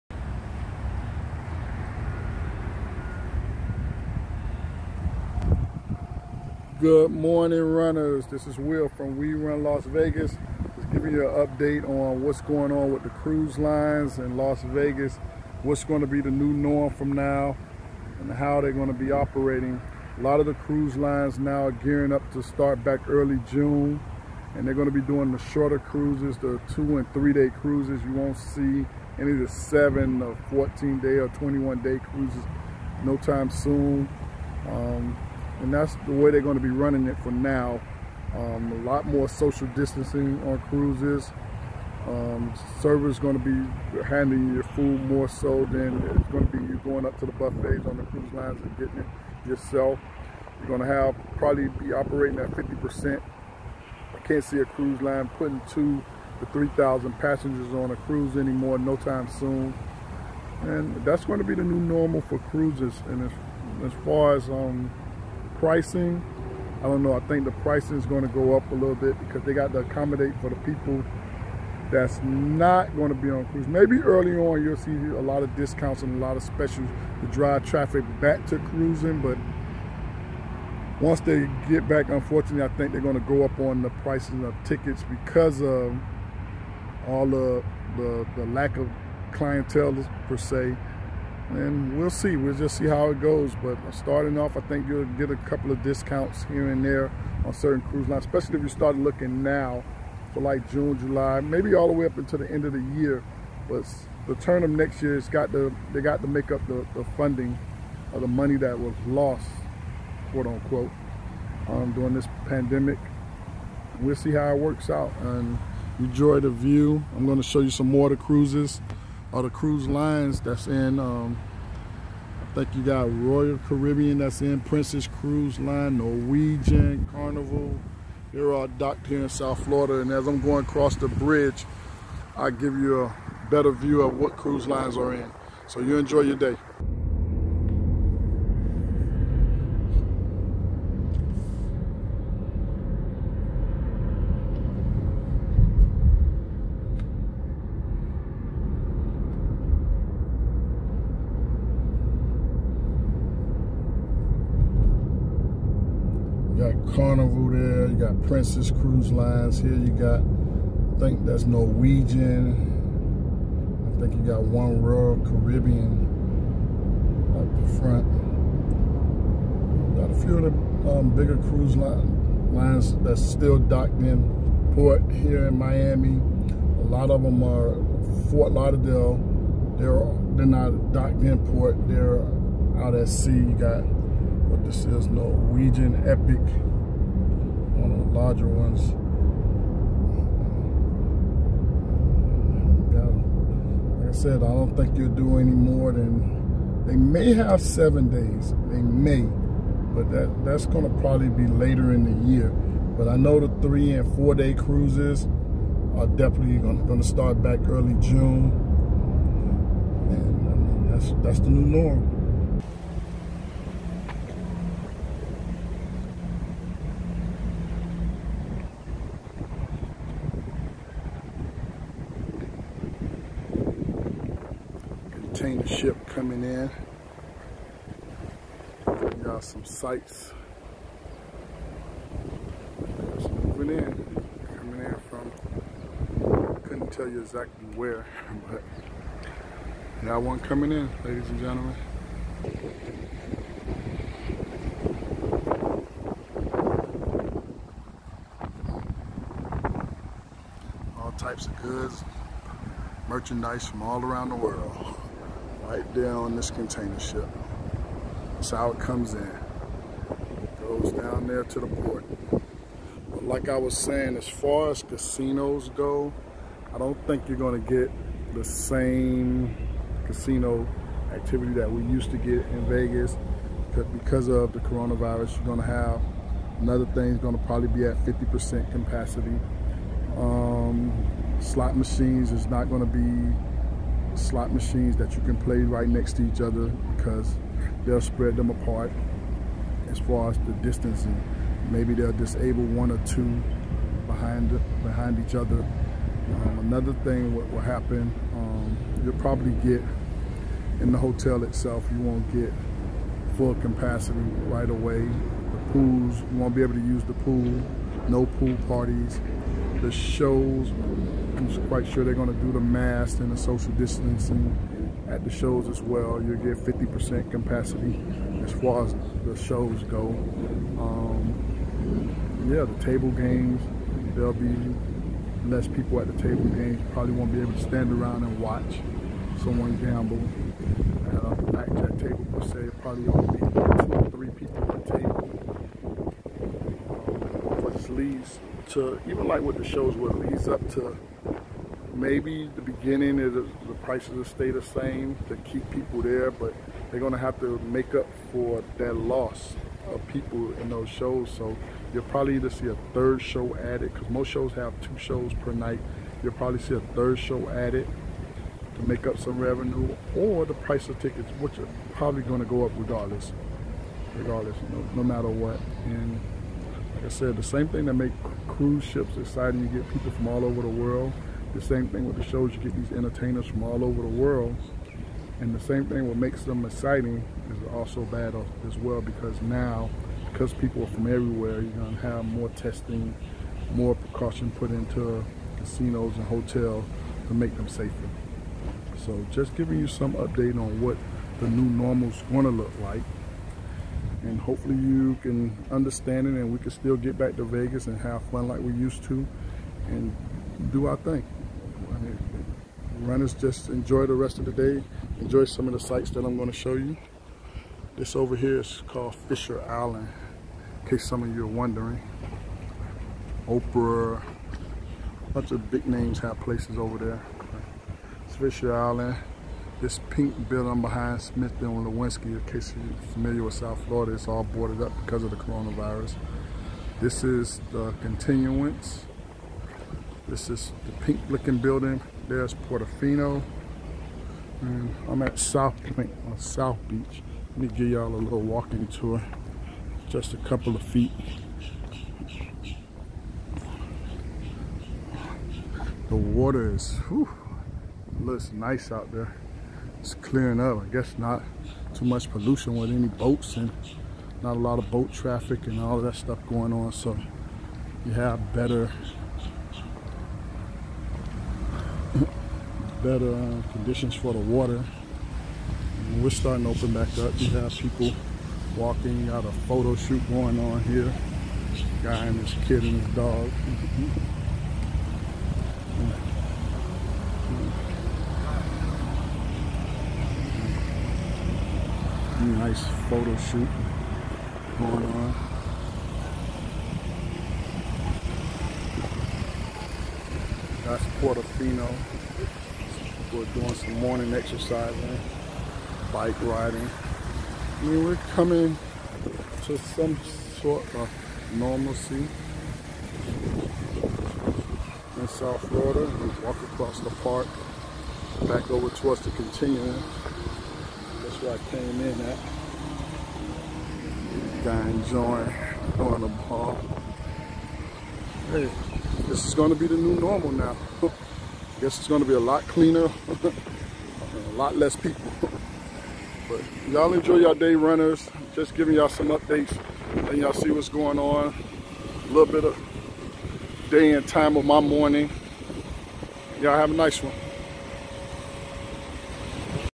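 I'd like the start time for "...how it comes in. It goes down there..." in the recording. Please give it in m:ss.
4:18.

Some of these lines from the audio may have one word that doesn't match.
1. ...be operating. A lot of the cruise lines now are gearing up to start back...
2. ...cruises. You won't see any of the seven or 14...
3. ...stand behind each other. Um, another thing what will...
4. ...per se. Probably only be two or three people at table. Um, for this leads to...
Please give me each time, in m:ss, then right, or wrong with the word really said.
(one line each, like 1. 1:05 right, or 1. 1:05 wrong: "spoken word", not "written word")
1. 0:18 right
2. 0:27 right
3. 4:54 wrong: "behind", not "stand"
4. 5:32 right.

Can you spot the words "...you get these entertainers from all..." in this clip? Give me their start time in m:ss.
6:12.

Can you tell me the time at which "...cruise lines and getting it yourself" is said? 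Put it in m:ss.
0:48.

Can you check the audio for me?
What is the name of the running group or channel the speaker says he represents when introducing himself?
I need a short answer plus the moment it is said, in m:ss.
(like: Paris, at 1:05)
We Run Las Vegas, at 0:09.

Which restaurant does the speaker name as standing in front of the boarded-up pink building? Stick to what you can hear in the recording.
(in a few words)
Smith and Wollensky.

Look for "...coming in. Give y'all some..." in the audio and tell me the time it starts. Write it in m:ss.
3:46.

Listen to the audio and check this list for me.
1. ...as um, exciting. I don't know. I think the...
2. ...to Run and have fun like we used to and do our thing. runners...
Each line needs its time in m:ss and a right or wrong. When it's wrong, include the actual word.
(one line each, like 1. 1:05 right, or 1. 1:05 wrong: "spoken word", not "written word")
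1. 1:04 wrong: "pricing", not "exciting"
2. 6:37 wrong: "Vegas", not "Run".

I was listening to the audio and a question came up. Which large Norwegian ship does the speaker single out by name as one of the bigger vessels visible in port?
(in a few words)
Norwegian Epic.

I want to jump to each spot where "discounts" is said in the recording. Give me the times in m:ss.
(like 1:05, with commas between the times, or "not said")
1:15, 1:35.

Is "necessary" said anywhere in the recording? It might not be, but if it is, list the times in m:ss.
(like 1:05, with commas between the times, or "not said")
not said.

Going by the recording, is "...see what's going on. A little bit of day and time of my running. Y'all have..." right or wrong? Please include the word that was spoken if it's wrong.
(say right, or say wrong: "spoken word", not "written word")
wrong: "morning", not "running".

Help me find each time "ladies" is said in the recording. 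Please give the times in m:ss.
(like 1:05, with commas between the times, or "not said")
4:01.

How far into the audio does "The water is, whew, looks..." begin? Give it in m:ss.
7:26.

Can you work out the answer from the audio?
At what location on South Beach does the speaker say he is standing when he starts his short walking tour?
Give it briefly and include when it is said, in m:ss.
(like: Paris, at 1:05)
South Pointe, at 7:15.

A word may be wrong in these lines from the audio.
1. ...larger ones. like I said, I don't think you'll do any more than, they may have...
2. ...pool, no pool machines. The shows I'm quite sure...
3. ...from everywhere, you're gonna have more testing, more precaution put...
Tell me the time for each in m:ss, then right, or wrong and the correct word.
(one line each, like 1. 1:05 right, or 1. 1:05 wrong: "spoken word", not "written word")
1. 3:08 right
2. 5:07 wrong: "parties", not "machines"
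3. 6:20 right.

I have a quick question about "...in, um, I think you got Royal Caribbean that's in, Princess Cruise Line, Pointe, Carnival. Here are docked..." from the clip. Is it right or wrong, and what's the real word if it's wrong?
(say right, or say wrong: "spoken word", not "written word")
wrong: "Norwegian", not "Pointe".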